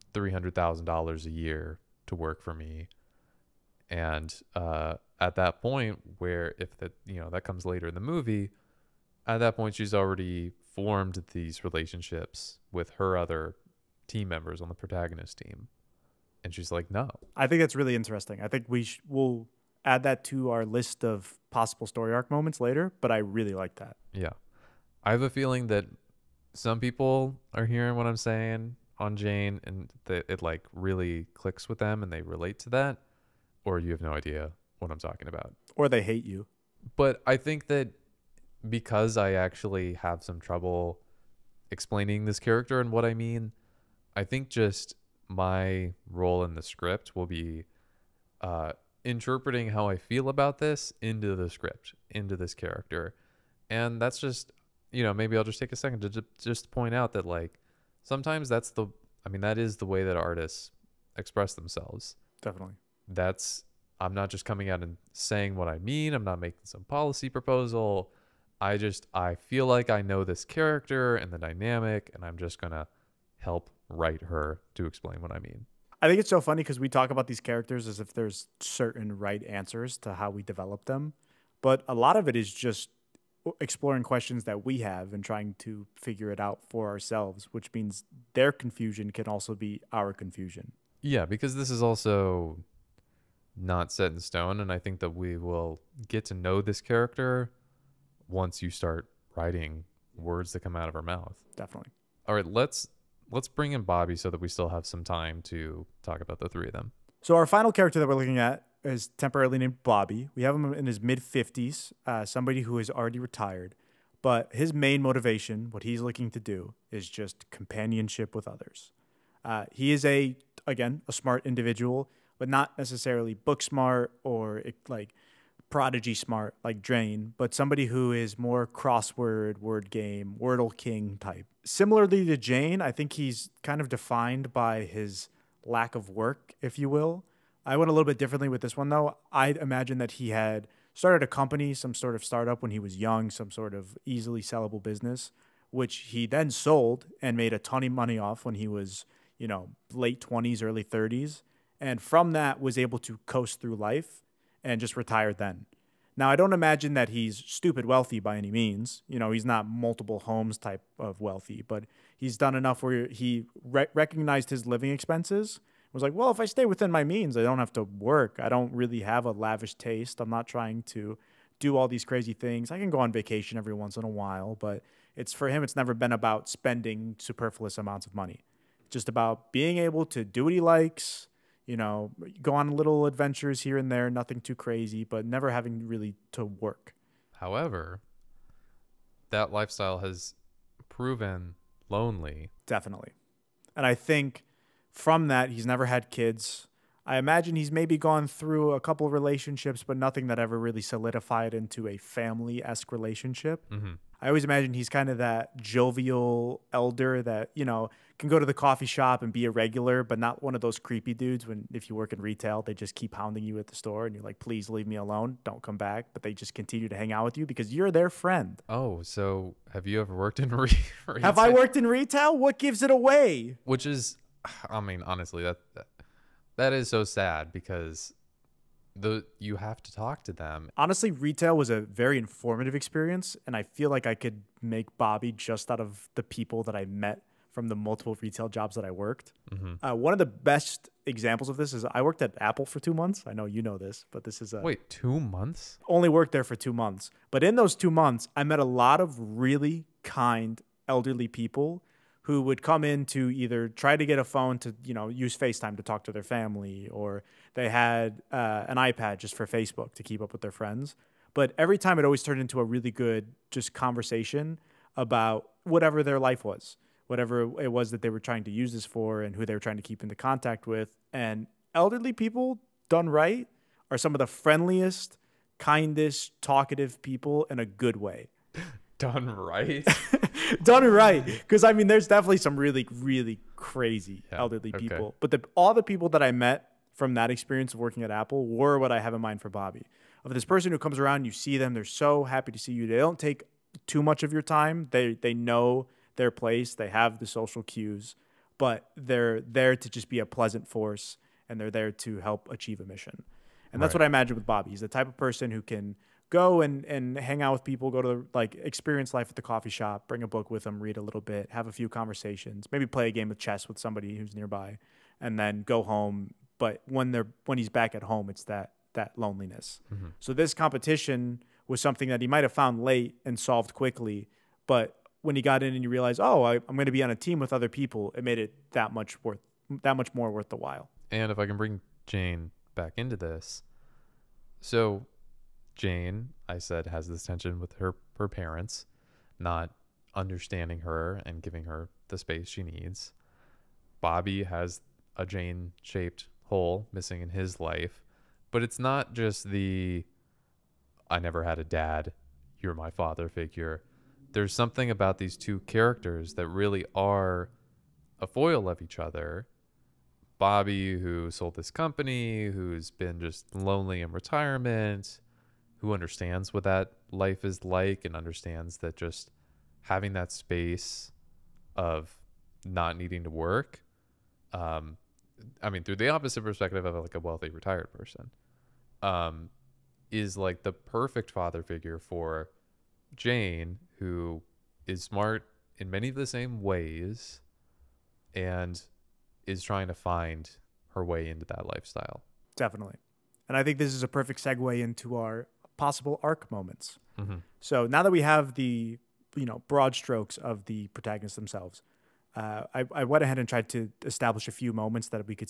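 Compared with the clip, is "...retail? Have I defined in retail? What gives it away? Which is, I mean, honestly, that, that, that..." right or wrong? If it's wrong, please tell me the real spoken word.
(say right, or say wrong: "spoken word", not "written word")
wrong: "worked", not "defined".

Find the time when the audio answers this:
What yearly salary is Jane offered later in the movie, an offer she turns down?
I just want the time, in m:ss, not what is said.
0:00.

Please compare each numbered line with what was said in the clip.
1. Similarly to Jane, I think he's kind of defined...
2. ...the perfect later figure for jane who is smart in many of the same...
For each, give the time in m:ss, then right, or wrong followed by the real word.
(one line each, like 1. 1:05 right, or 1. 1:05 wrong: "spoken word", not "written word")
1. 2:11 right
2. 6:20 wrong: "father", not "later".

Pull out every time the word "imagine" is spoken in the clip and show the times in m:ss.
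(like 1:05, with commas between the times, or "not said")
2:19, 2:36, 3:17, 3:24, 5:04.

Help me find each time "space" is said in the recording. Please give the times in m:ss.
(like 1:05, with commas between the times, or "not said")
5:42, 6:10.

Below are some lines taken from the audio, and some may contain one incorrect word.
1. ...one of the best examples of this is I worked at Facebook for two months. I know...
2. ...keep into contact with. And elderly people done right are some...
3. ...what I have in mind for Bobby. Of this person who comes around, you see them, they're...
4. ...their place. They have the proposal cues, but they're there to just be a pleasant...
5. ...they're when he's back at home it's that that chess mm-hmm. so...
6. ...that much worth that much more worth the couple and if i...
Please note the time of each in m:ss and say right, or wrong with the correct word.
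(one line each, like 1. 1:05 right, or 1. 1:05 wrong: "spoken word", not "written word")
1. 3:59 wrong: "Apple", not "Facebook"
2. 4:29 right
3. 4:48 right
4. 4:56 wrong: "social", not "proposal"
5. 5:17 wrong: "loneliness", not "chess"
6. 5:28 wrong: "while", not "couple".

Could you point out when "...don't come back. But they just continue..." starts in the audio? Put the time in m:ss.
3:35.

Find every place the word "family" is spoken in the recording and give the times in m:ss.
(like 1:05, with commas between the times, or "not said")
3:21, 4:16.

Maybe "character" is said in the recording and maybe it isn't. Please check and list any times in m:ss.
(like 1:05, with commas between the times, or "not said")
0:42, 0:52, 1:10, 1:17, 1:36, 1:47, 5:55.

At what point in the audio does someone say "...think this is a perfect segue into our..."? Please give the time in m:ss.
6:33.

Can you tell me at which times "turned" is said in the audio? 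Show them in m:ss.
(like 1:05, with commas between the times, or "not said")
4:22.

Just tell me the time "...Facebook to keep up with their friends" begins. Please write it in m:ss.
4:19.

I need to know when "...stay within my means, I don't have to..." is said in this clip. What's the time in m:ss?
2:46.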